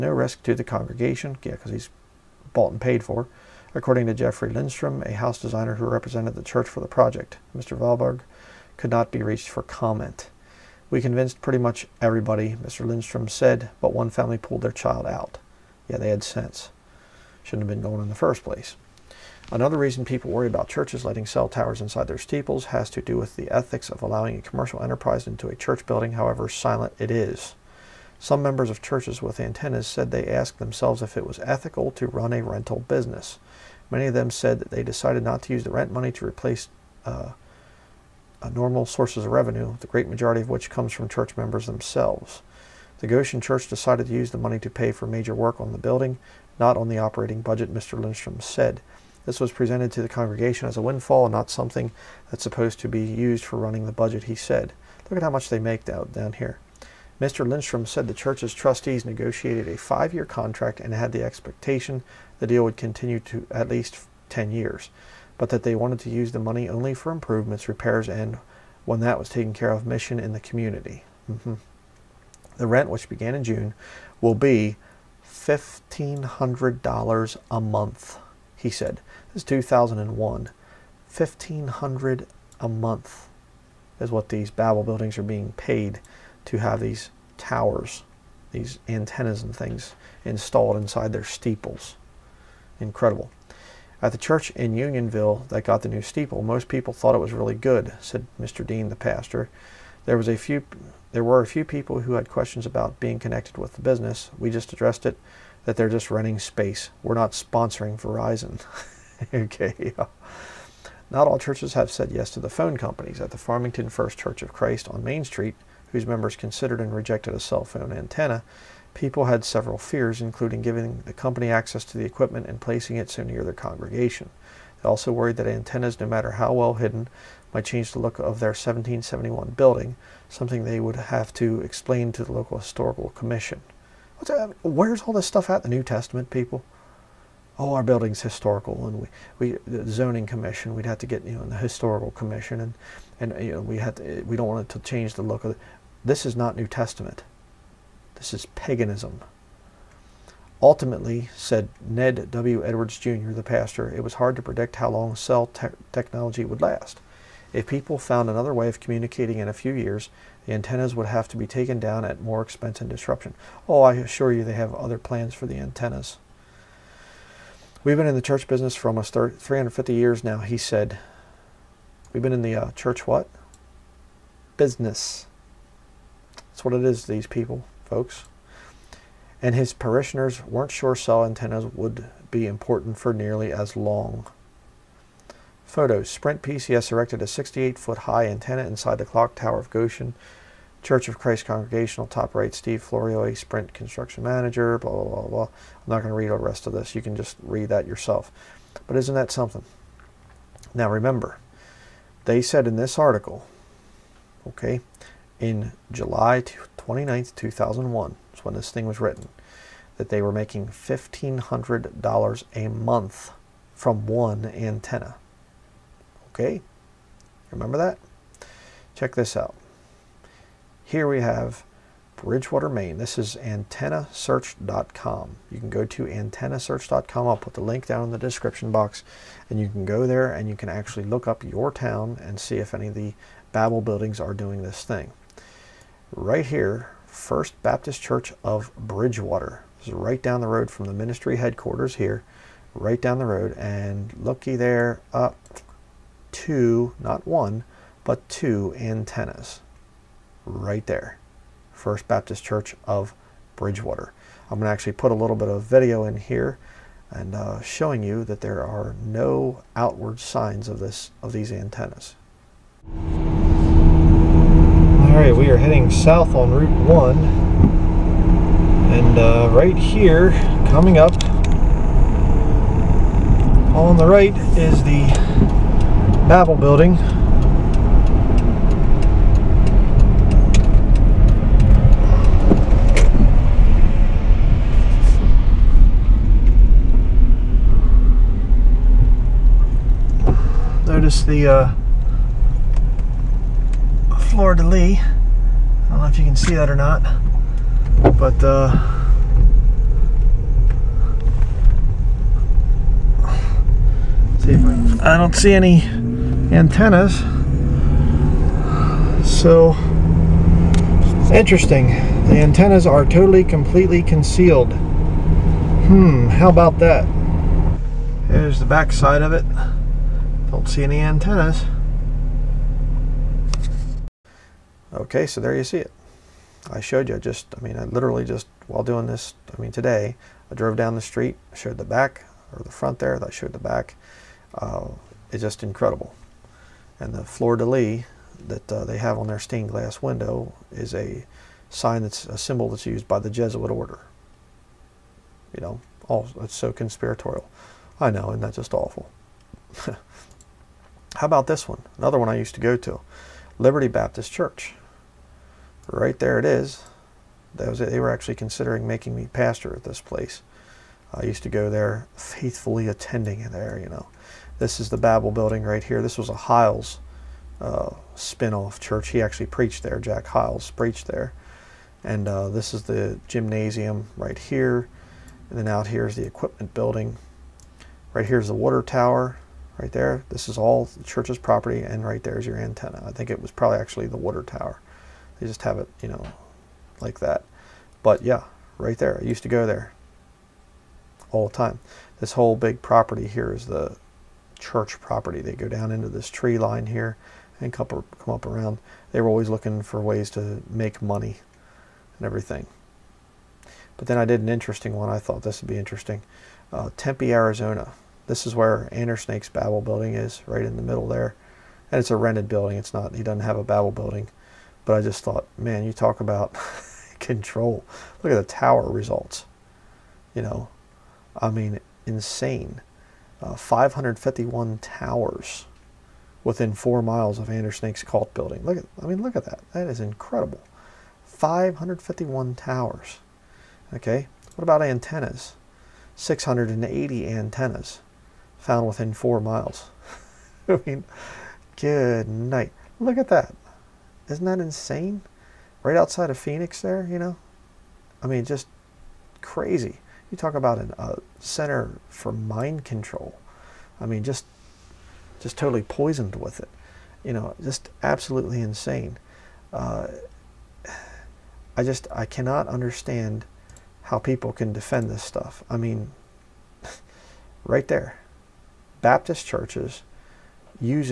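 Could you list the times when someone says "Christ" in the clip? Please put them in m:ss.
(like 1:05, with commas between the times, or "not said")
1:54, 3:11.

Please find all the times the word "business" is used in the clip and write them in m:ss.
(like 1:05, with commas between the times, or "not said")
0:32, 1:43, 2:48, 2:54.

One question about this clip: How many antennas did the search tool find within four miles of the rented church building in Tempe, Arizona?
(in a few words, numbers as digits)
680.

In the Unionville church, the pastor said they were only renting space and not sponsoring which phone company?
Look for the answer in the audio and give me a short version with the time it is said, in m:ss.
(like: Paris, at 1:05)
Verizon, at 1:48.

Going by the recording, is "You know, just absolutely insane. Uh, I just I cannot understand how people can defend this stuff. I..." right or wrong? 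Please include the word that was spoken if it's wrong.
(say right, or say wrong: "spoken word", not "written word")
right.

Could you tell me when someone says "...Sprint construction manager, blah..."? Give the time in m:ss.
3:13.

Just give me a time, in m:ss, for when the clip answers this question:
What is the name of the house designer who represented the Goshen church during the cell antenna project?
0:04.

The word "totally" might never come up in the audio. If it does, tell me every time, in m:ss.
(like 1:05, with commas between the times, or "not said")
5:13, 7:35.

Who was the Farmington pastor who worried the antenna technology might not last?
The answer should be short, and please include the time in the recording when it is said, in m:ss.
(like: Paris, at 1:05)
Ned W. Edwards Jr., at 2:31.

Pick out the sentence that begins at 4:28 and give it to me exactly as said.
And uh, right here, coming up, on the right is the Babel building.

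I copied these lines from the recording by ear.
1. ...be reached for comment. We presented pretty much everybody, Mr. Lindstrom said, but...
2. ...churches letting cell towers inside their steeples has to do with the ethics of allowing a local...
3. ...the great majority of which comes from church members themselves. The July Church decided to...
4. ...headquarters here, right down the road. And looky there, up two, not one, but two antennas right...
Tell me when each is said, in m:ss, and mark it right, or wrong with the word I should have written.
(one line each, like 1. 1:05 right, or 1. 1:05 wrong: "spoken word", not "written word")
1. 0:09 wrong: "convinced", not "presented"
2. 0:20 wrong: "commercial", not "local"
3. 0:39 wrong: "Goshen", not "July"
4. 4:01 right.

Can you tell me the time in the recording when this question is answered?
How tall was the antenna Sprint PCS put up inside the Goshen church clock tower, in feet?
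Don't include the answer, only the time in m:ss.
3:07.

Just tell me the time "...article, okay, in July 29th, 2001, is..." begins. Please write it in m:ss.
3:22.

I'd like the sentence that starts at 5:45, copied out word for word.
You know, all, it's so conspiratorial.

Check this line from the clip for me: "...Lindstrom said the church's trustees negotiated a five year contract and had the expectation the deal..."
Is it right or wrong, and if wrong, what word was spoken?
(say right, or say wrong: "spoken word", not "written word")
right.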